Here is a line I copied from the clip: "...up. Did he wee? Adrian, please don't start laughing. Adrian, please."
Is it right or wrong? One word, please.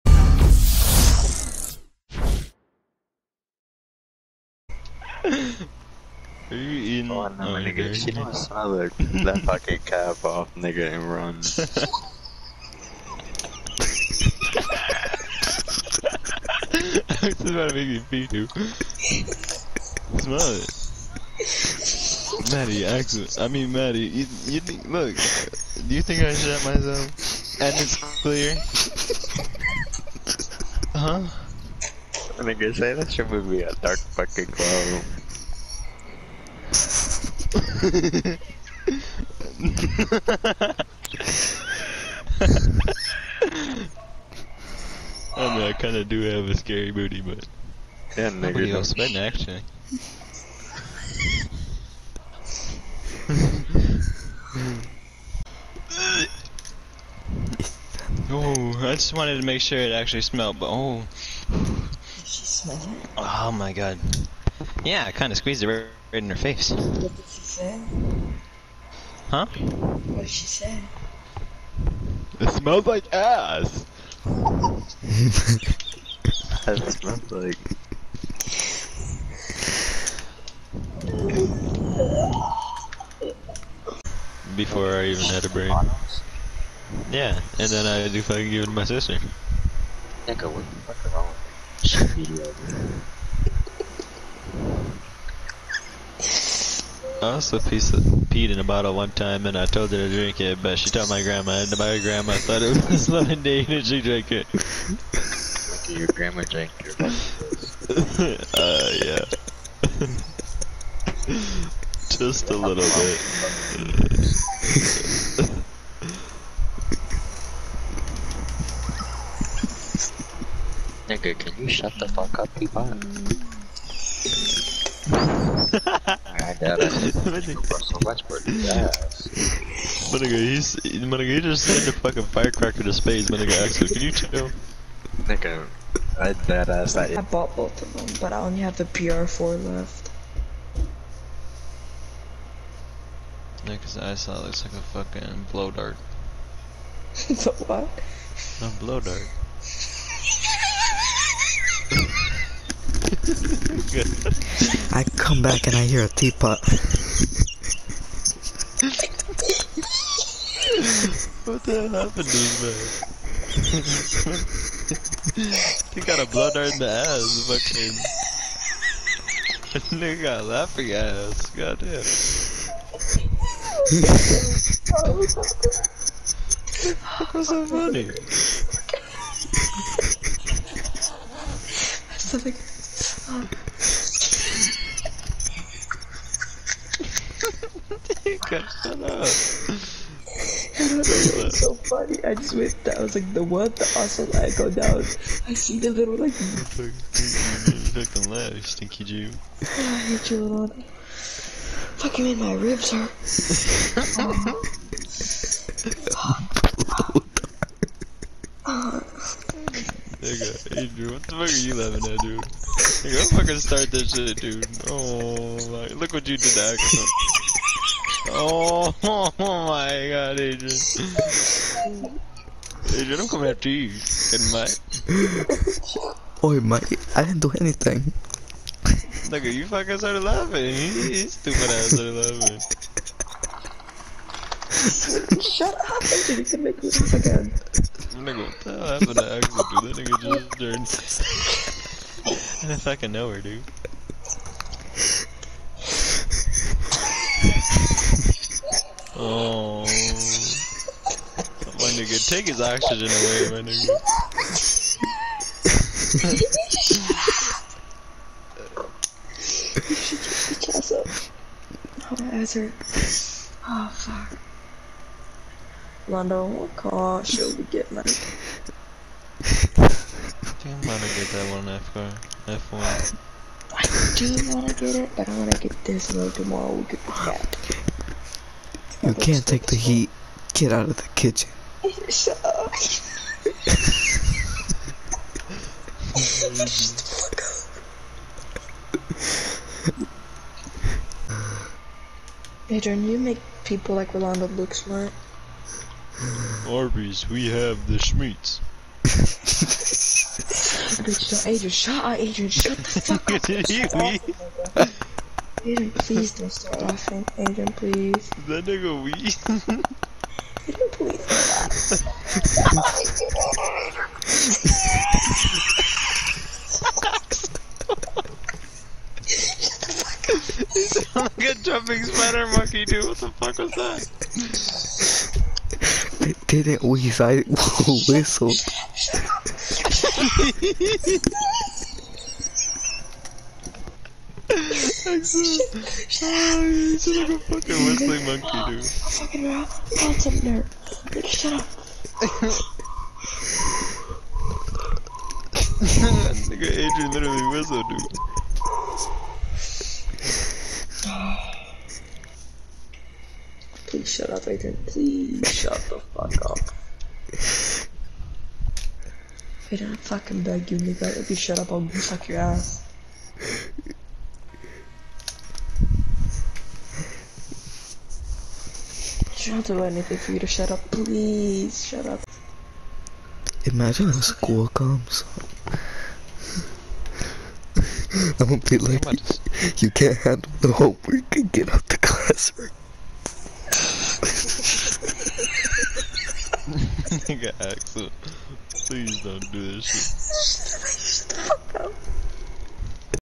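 right.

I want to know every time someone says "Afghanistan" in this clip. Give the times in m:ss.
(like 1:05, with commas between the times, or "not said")
not said.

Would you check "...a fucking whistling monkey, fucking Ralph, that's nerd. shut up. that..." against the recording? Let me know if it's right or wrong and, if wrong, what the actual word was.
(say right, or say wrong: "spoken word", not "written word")
right.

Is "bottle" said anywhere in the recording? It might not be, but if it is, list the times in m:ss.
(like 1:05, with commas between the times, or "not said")
1:38.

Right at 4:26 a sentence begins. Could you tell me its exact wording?
Londo, what car should we get, man?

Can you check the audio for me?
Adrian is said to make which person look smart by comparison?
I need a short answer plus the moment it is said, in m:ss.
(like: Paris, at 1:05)
Rolando, at 4:54.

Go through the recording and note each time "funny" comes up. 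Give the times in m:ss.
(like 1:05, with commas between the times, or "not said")
2:57, 3:11.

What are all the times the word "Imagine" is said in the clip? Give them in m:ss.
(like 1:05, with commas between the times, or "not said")
1:02, 6:13.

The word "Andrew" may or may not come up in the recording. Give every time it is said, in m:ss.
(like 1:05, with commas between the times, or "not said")
3:56.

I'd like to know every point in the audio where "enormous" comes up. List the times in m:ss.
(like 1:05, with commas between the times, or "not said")
not said.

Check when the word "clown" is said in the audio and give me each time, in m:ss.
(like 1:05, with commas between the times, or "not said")
0:34.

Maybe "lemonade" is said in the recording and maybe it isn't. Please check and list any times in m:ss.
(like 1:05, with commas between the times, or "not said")
1:43.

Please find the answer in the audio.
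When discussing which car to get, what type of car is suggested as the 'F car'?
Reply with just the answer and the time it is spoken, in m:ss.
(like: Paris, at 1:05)
F1, at 4:32.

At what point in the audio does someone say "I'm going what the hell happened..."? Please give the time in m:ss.
3:58.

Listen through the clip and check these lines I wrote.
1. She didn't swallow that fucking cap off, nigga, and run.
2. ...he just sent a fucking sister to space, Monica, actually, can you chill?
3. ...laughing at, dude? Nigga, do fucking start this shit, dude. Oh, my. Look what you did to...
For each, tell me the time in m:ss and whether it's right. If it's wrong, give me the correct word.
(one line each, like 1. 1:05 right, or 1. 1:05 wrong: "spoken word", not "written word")
1. 0:07 right
2. 2:11 wrong: "firecracker", not "sister"
3. 3:31 right.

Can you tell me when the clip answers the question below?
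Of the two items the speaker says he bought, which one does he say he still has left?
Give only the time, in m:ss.
2:18.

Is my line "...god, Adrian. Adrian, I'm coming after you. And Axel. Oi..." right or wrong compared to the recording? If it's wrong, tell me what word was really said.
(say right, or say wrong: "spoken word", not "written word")
wrong: "Mike", not "Axel".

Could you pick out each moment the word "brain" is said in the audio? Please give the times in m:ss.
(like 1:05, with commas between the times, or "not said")
1:25.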